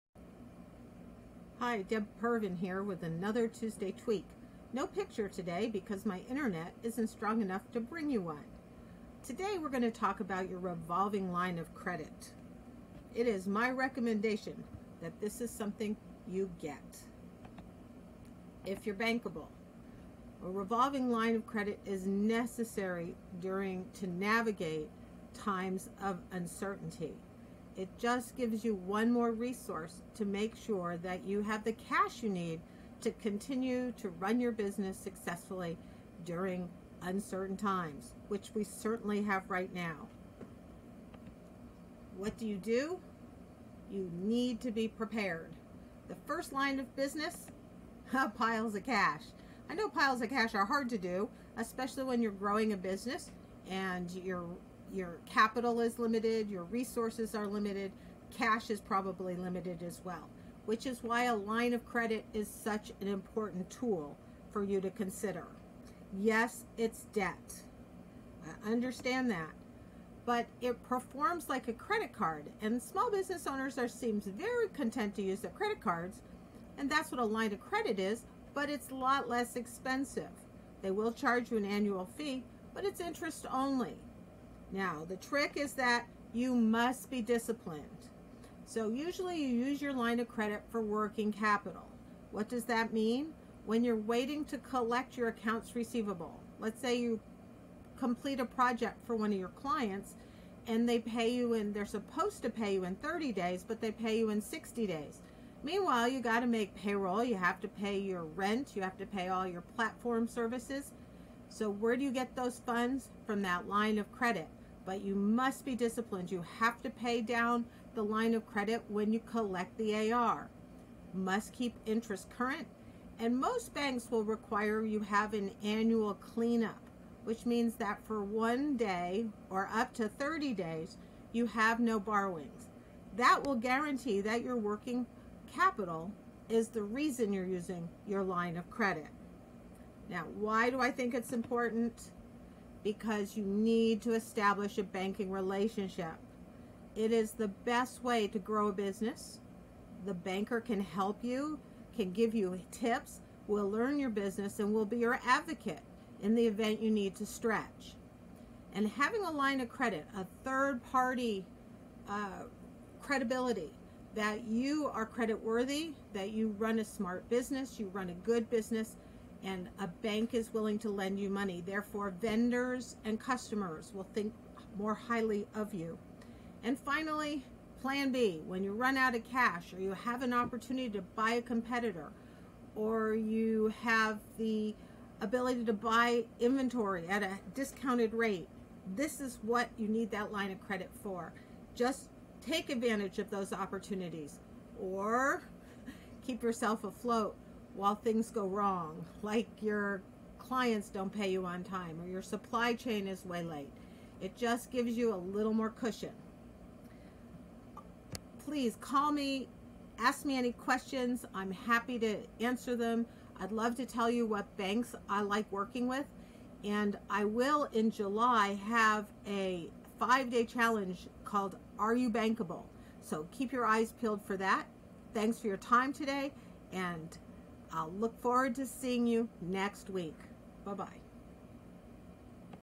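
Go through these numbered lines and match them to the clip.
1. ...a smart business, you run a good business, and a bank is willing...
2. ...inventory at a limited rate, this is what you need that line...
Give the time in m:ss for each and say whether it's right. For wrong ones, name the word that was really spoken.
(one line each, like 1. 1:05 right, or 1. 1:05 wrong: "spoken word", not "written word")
1. 2:46 right
2. 3:06 wrong: "discounted", not "limited".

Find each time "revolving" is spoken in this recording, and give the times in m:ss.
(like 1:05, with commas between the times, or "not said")
0:10, 0:20.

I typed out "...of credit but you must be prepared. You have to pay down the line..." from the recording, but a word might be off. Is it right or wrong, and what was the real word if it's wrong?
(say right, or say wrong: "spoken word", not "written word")
wrong: "disciplined", not "prepared".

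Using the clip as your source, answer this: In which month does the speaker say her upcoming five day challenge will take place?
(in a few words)
July.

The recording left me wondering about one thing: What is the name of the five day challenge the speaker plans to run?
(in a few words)
Are You Bankable?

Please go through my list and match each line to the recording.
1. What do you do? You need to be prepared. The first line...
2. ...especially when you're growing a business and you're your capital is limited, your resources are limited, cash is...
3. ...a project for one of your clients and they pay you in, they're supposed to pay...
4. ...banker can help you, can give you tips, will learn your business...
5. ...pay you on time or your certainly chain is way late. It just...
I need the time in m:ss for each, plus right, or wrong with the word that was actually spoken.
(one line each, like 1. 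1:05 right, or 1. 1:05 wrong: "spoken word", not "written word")
1. 0:42 right
2. 0:51 right
3. 1:38 right
4. 2:30 right
5. 3:21 wrong: "supply", not "certainly".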